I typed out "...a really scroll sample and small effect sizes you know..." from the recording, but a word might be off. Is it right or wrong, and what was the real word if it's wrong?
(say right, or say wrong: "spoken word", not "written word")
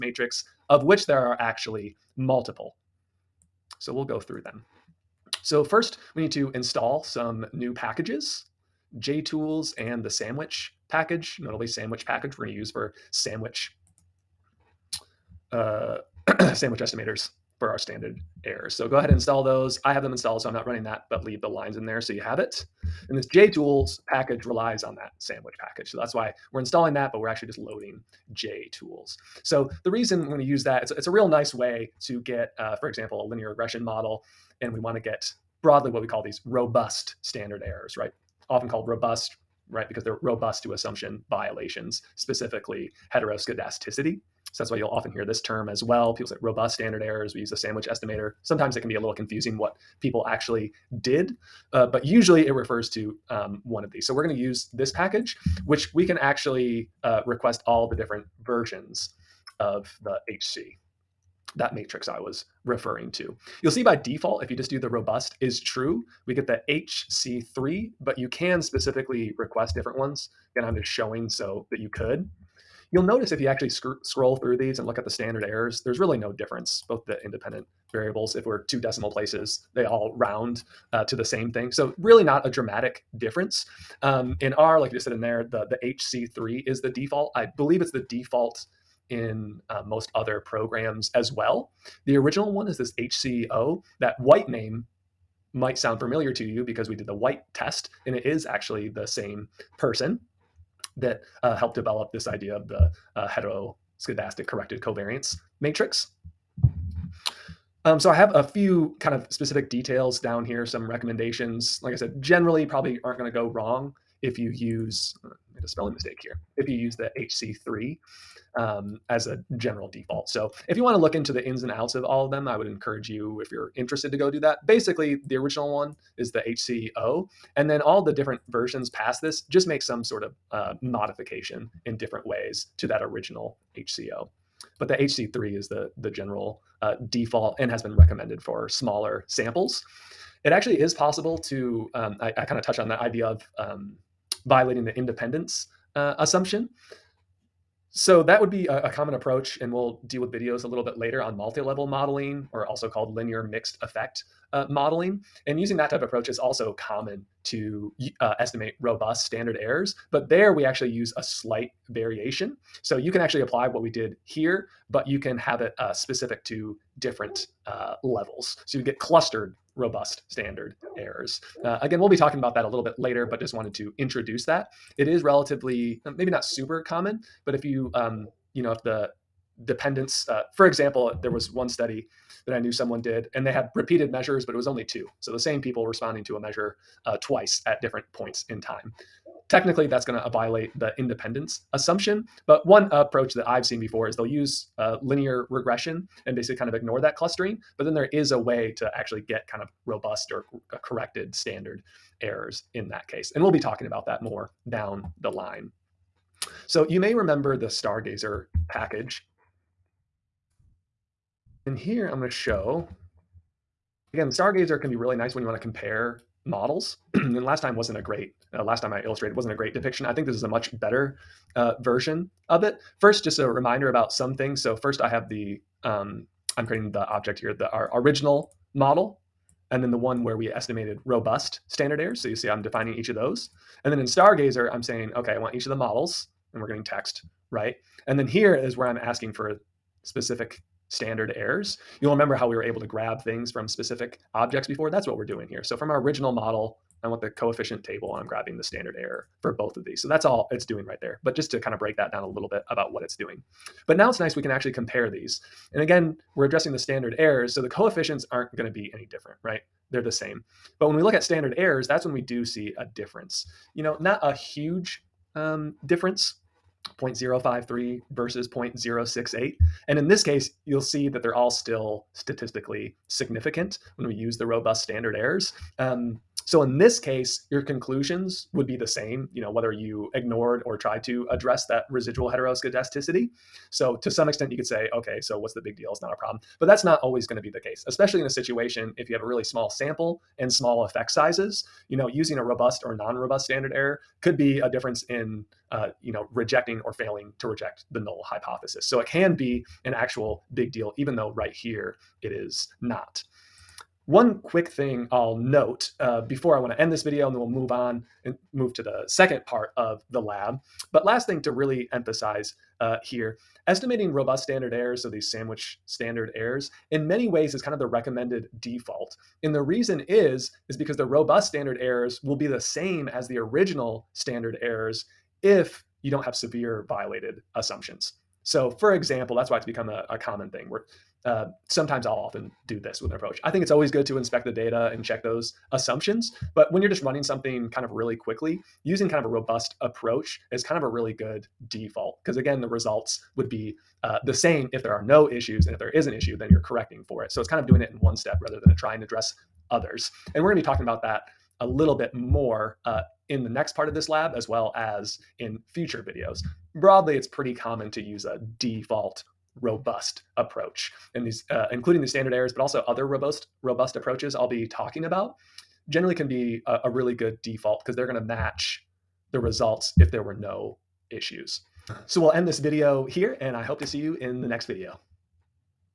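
wrong: "small", not "scroll".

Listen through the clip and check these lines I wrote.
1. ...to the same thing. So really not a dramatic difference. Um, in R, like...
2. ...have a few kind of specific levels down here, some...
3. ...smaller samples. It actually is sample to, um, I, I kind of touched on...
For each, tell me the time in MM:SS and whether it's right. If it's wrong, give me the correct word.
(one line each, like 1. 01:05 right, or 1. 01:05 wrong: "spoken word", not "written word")
1. 01:21 right
2. 01:48 wrong: "details", not "levels"
3. 02:18 wrong: "possible", not "sample".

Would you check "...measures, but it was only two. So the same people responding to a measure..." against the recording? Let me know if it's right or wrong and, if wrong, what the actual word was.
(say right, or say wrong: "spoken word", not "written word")
right.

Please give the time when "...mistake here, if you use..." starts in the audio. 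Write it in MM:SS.
01:55.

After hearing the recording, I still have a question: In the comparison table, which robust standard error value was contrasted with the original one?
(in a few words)
0.068.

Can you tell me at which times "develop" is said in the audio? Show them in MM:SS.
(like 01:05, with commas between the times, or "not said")
01:41.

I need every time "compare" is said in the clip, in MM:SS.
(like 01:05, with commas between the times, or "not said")
03:35, 04:14.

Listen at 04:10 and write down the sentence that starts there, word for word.
So that's all it's doing right there.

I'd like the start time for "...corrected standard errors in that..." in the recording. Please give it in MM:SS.
03:20.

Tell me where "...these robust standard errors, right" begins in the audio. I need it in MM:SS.
00:36.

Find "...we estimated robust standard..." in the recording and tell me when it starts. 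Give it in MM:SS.
03:50.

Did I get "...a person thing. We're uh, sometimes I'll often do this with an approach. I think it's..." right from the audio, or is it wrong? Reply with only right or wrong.
wrong.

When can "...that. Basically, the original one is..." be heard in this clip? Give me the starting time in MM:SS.
02:04.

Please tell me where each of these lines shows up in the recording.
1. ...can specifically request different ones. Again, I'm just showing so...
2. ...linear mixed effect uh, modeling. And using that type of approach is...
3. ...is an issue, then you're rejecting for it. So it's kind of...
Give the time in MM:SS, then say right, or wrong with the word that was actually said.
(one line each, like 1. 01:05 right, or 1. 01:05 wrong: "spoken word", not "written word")
1. 01:08 right
2. 02:33 right
3. 05:45 wrong: "correcting", not "rejecting".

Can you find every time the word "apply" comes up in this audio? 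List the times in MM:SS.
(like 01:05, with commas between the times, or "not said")
02:43.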